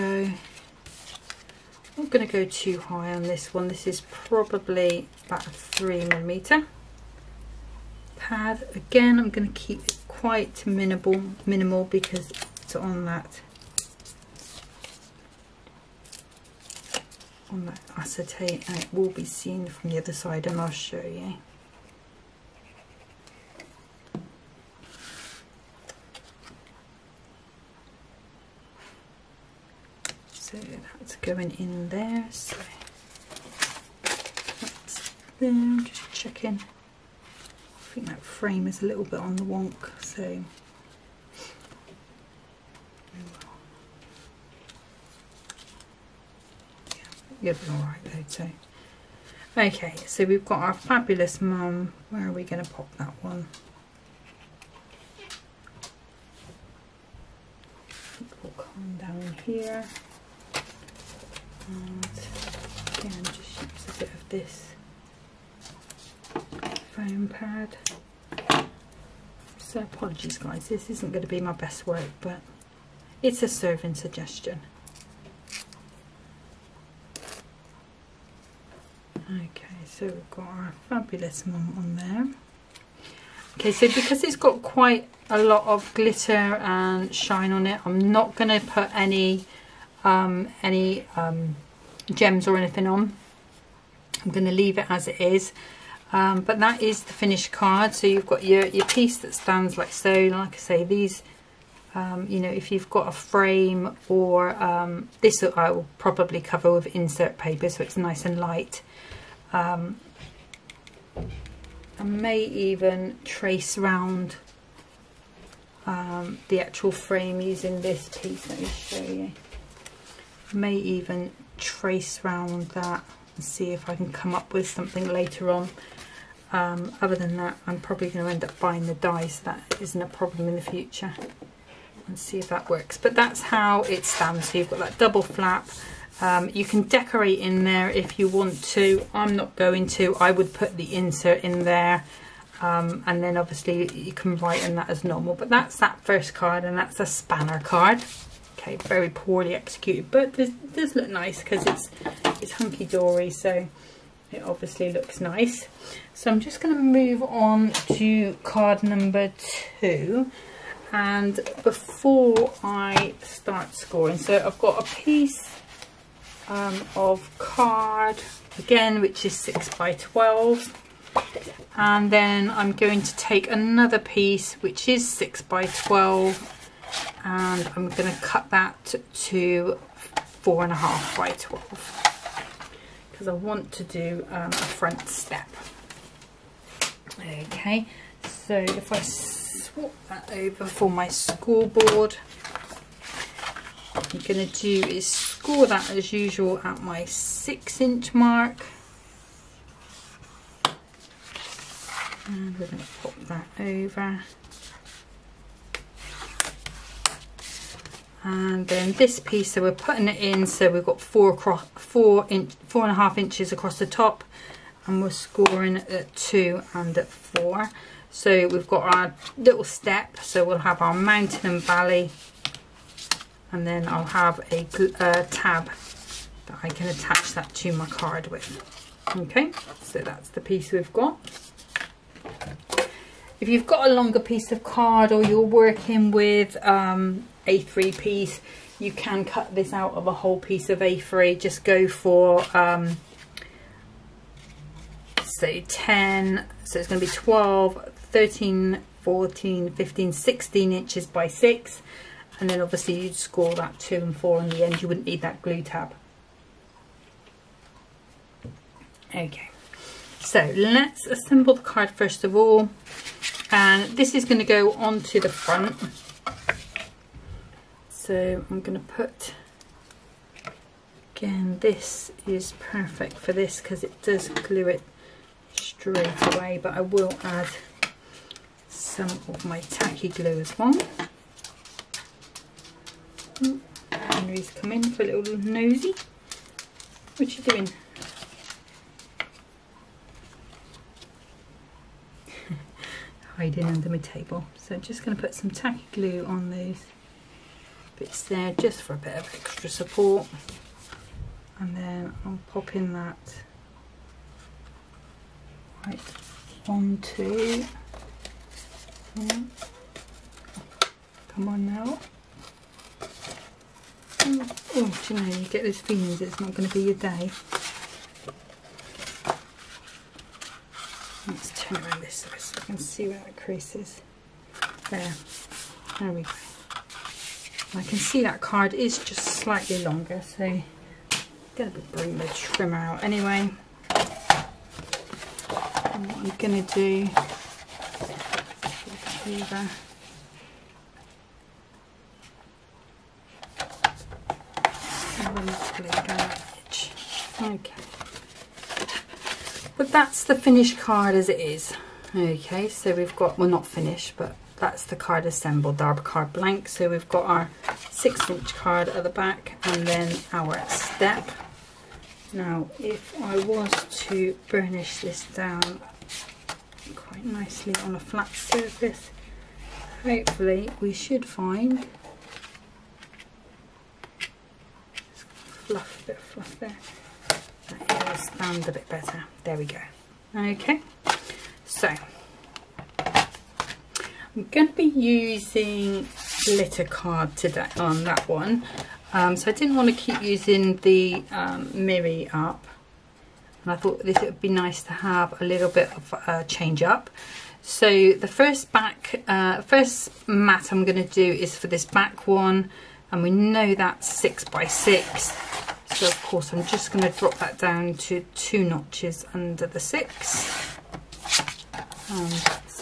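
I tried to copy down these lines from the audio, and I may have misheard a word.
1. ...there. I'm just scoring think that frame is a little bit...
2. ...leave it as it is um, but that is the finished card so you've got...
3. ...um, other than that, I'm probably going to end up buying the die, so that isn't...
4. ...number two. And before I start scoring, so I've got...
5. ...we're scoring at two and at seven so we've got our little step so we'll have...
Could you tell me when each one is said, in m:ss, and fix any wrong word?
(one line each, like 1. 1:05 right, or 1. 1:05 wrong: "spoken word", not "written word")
1. 0:35 wrong: "checking", not "scoring"
2. 1:34 right
3. 2:06 right
4. 2:38 right
5. 3:35 wrong: "four", not "seven".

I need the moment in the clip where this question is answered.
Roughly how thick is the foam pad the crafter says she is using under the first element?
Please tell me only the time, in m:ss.
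0:05.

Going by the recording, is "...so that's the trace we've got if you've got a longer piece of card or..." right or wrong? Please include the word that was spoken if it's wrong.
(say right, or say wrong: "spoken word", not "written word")
wrong: "piece", not "trace".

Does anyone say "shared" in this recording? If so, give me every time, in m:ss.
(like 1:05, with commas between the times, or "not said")
not said.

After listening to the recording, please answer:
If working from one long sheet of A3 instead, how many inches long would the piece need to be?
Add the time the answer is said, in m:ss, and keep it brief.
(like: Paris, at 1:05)
16 inches, at 4:10.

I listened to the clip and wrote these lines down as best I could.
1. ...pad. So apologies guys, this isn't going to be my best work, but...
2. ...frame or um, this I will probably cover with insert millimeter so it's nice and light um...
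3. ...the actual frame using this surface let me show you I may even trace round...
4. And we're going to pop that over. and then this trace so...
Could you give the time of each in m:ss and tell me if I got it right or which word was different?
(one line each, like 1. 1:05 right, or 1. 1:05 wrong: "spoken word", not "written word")
1. 1:07 right
2. 1:43 wrong: "paper", not "millimeter"
3. 1:56 wrong: "piece", not "surface"
4. 3:22 wrong: "piece", not "trace".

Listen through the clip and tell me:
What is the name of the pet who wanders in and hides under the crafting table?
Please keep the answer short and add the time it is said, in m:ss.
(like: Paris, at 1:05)
Henry, at 4:43.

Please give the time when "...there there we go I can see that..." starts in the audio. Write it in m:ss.
5:24.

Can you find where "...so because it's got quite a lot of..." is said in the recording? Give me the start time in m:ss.
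1:23.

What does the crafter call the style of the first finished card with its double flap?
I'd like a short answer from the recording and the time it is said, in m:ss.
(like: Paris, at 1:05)
spanner card, at 2:27.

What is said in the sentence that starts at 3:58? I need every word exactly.
You can cut this out of a whole piece of A3.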